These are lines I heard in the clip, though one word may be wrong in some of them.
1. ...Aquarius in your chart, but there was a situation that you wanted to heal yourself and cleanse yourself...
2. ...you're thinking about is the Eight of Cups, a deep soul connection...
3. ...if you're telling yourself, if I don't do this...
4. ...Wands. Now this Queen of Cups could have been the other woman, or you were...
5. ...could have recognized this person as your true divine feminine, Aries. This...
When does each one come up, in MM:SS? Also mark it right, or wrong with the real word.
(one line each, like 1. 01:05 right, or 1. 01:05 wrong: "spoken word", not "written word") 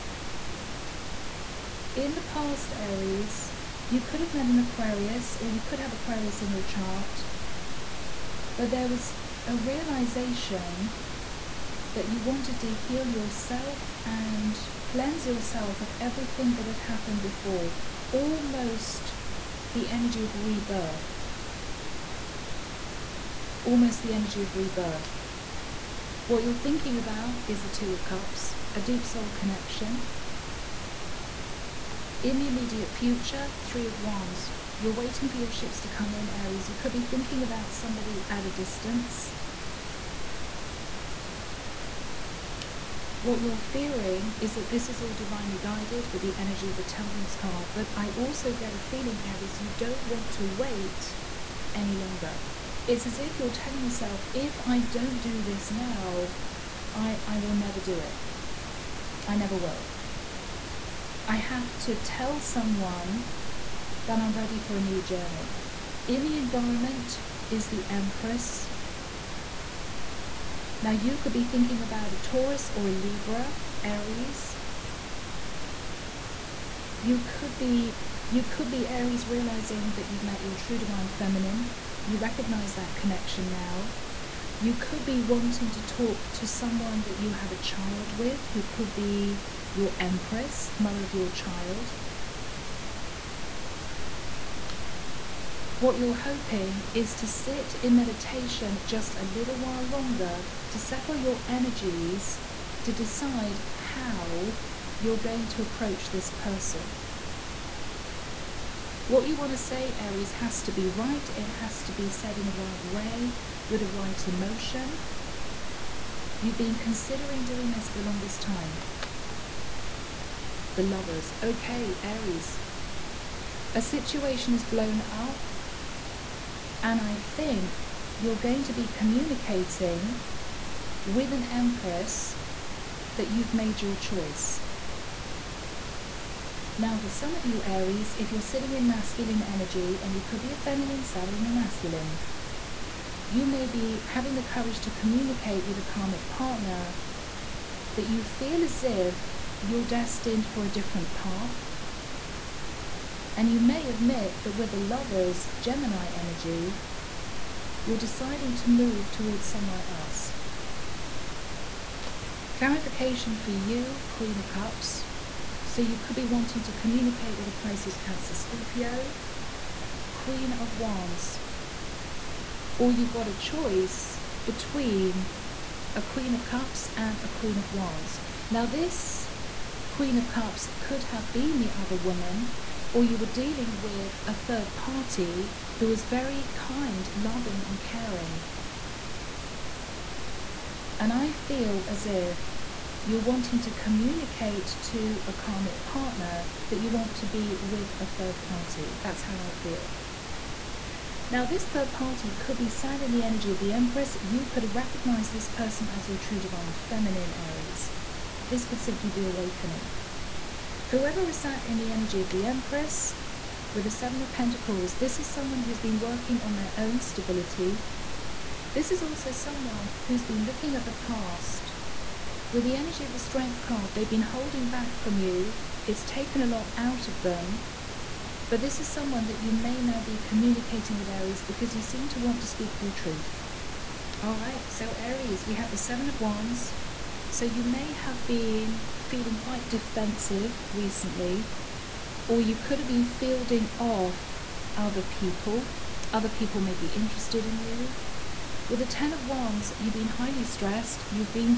1. 00:05 wrong: "realization", not "situation"
2. 00:26 wrong: "Two", not "Eight"
3. 00:53 right
4. 02:57 right
5. 03:24 right.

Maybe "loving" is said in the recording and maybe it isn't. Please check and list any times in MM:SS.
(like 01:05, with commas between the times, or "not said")
03:07.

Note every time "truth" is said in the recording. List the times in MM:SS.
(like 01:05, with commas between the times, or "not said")
03:52.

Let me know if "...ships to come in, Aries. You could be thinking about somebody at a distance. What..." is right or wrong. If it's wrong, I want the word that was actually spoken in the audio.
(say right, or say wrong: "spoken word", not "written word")
right.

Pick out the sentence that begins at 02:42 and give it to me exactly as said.
Clarification for you, Queen of Cups.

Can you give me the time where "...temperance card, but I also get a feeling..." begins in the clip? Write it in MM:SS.
00:46.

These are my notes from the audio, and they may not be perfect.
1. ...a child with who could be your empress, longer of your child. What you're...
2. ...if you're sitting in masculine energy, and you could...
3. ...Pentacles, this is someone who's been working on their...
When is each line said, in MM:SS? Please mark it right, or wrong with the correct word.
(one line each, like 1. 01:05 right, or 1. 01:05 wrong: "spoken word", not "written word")
1. 01:27 wrong: "mother", not "longer"
2. 02:18 right
3. 03:34 right.